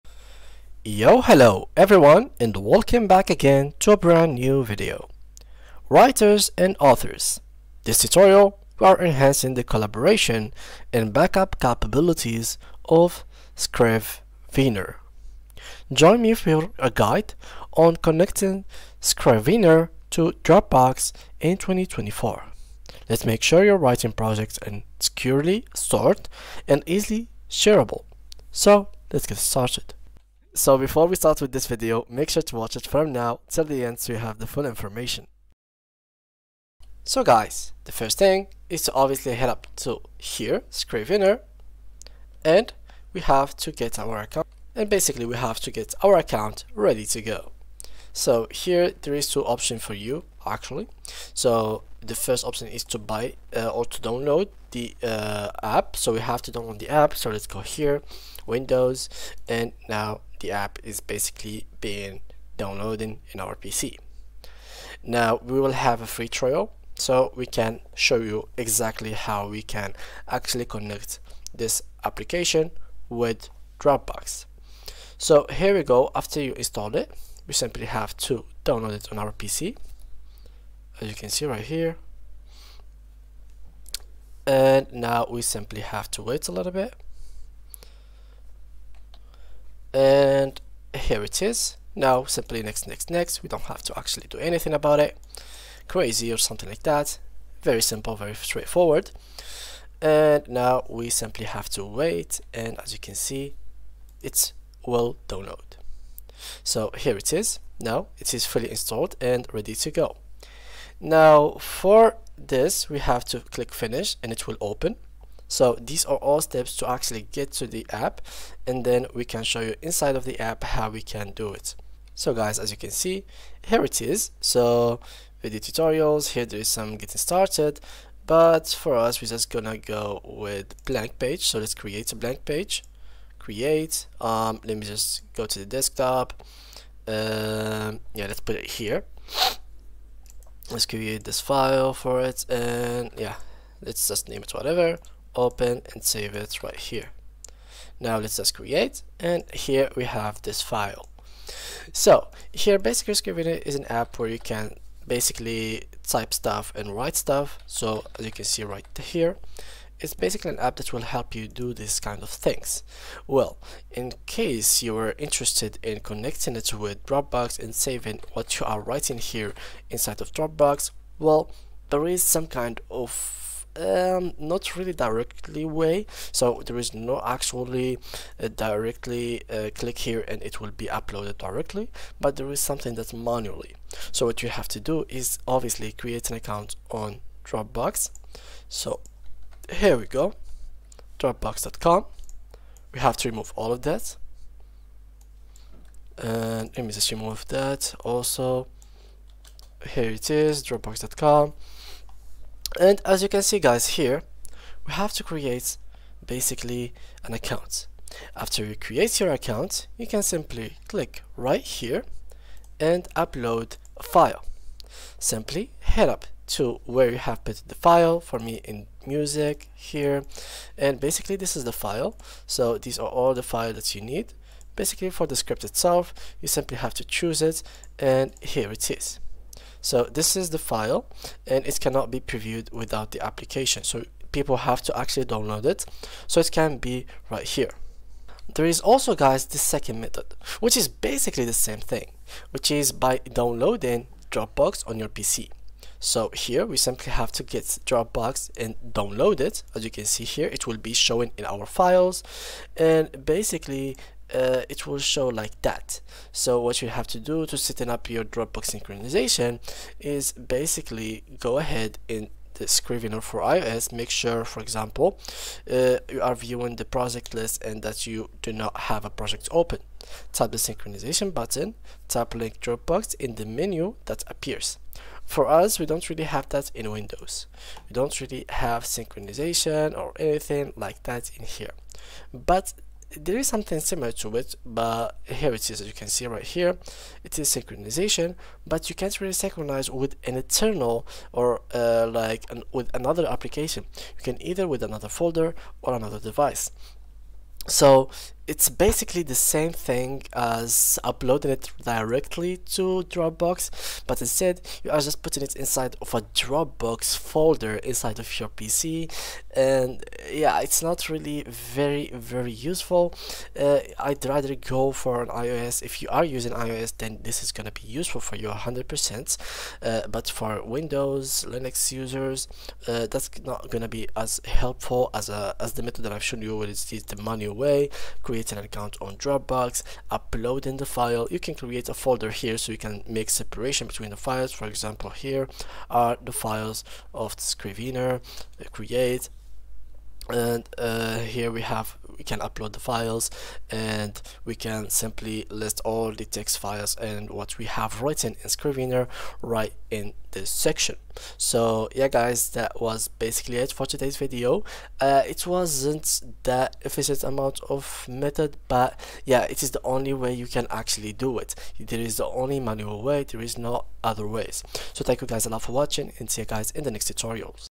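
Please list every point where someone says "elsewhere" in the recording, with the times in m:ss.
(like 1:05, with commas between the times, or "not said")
not said.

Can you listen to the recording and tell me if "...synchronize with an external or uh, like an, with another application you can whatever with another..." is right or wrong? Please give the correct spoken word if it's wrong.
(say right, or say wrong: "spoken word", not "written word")
wrong: "either", not "whatever".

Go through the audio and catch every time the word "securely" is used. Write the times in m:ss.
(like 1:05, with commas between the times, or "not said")
0:24.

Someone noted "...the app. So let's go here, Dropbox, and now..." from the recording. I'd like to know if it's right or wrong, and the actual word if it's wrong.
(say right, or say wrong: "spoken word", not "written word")
wrong: "Windows", not "Dropbox".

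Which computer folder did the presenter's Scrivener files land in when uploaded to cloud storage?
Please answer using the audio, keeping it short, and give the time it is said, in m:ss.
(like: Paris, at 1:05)
music, at 3:39.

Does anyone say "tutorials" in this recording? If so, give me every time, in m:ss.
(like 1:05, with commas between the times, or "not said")
0:07, 2:05, 6:07.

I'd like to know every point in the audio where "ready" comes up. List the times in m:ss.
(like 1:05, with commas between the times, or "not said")
0:46, 1:49.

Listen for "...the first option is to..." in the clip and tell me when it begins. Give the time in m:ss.
0:52.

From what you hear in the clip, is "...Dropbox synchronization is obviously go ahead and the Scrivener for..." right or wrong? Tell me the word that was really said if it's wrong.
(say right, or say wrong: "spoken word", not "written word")
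wrong: "basically", not "obviously".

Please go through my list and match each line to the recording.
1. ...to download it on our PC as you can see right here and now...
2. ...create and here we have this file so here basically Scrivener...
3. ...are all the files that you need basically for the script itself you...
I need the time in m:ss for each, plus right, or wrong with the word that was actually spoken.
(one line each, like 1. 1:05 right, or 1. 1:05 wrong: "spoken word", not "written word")
1. 1:18 right
2. 2:28 right
3. 3:42 right.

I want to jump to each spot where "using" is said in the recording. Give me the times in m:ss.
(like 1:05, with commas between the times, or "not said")
5:16.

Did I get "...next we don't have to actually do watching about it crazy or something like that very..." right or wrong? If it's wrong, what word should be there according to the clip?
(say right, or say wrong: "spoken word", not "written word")
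wrong: "anything", not "watching".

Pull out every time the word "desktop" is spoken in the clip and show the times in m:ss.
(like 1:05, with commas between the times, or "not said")
2:15.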